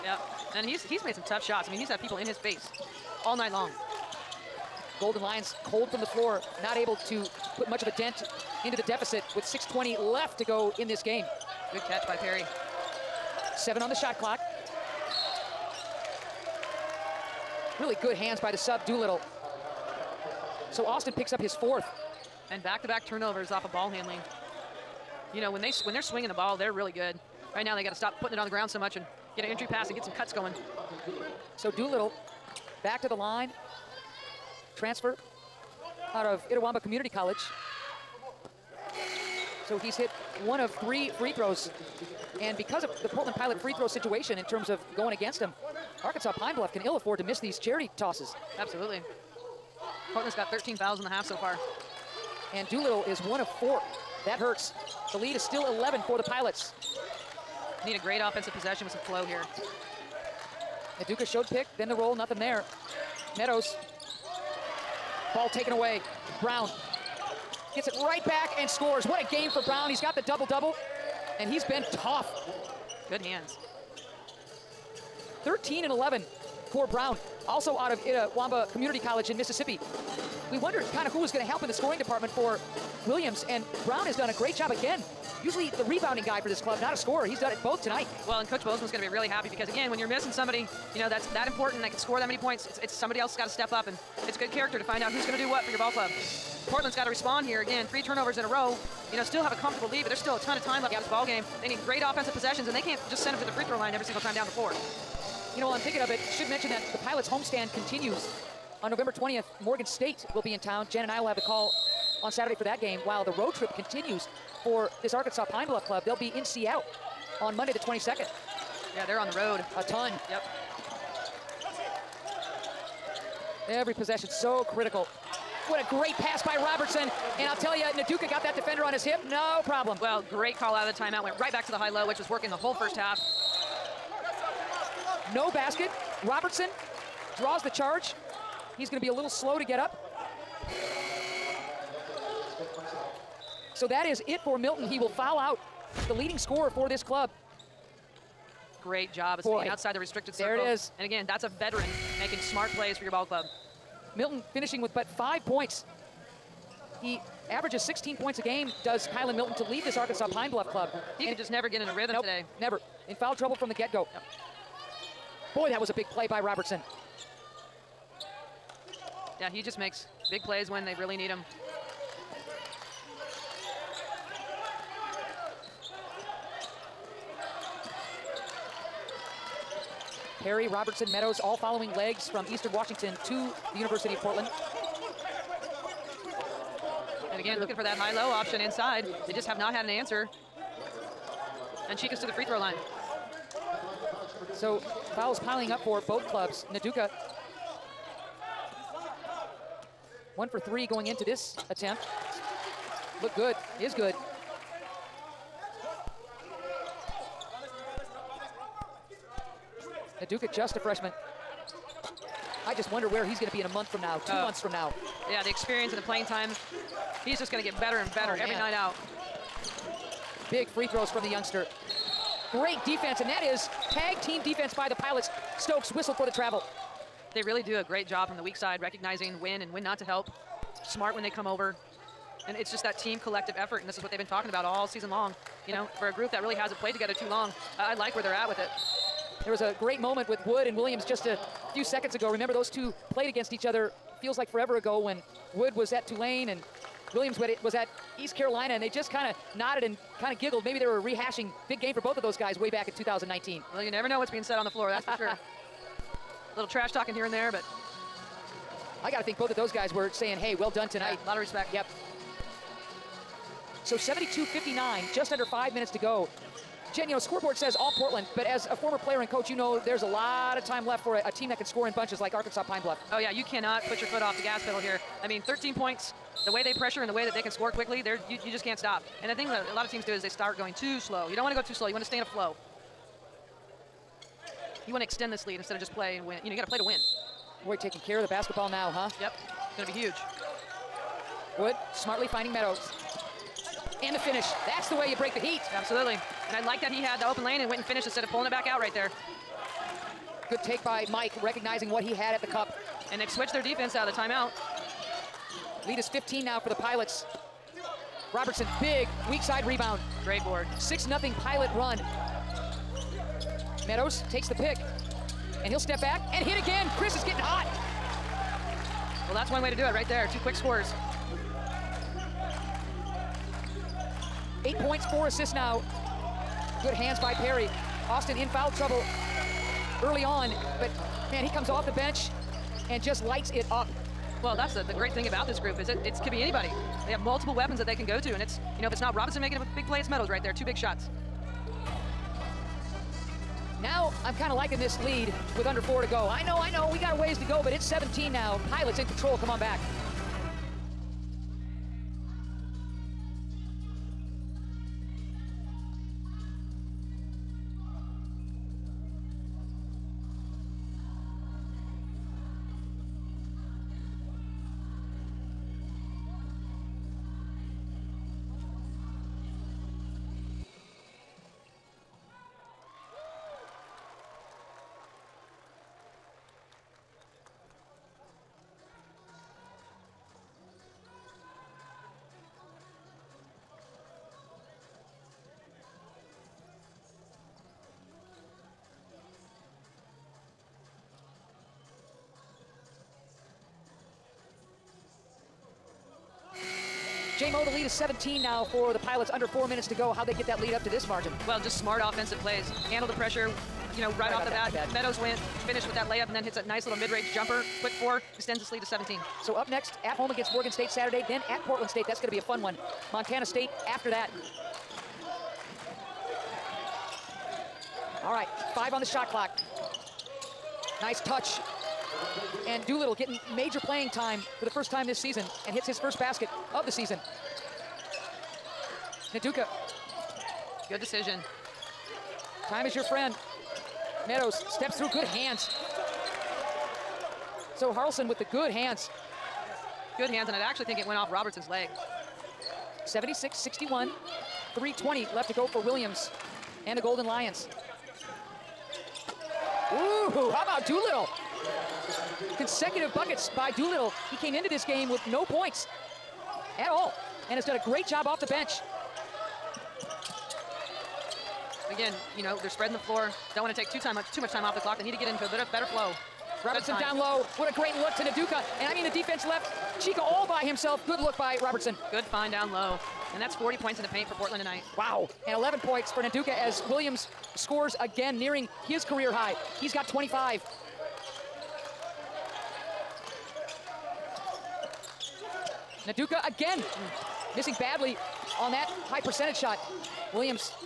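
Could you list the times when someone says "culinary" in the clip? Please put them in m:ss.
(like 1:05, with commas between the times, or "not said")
not said.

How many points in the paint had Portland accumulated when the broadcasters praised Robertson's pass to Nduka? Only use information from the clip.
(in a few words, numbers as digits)
40.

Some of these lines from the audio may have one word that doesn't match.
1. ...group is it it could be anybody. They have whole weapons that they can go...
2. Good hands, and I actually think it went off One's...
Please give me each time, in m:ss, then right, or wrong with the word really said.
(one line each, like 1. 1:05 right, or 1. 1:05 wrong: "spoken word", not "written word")
1. 5:35 wrong: "multiple", not "whole"
2. 7:20 wrong: "Robertson", not "One".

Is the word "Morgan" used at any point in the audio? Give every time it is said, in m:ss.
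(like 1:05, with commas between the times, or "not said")
1:49, 6:50.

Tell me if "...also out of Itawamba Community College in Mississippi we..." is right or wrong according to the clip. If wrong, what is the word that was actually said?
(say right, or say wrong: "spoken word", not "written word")
right.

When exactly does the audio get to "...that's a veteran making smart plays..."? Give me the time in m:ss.
2:31.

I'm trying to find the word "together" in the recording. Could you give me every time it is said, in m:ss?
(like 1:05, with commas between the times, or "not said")
3:56.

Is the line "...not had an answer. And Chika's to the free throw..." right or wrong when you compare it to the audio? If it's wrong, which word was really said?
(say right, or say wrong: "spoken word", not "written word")
right.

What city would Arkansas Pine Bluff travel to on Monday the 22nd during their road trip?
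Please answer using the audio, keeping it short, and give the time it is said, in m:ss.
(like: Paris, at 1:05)
Seattle, at 1:56.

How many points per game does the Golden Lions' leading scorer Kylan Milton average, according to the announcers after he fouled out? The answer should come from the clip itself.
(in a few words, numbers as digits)
16.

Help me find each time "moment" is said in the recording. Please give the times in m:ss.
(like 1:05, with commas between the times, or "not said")
3:59.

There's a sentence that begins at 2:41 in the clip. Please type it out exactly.
He and could just never get in a rhythm nope, today.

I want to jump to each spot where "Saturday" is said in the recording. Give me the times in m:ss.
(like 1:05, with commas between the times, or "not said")
1:52, 6:50.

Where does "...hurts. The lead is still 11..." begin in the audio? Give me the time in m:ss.
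0:54.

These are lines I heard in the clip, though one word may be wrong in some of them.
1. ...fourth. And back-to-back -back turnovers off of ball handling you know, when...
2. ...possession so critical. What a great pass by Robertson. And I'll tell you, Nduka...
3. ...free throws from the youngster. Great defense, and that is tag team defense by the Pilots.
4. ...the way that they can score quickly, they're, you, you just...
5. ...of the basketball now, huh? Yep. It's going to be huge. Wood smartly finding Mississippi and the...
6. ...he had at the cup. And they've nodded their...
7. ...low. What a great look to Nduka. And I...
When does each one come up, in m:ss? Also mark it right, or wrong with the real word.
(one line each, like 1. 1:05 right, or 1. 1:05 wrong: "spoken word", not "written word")
1. 0:21 right
2. 2:03 right
3. 3:40 right
4. 4:37 right
5. 4:48 wrong: "Meadows", not "Mississippi"
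6. 5:02 wrong: "switched", not "nodded"
7. 7:47 right.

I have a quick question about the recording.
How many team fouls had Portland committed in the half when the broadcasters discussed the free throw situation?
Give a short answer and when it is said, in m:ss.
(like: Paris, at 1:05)
13, at 0:50.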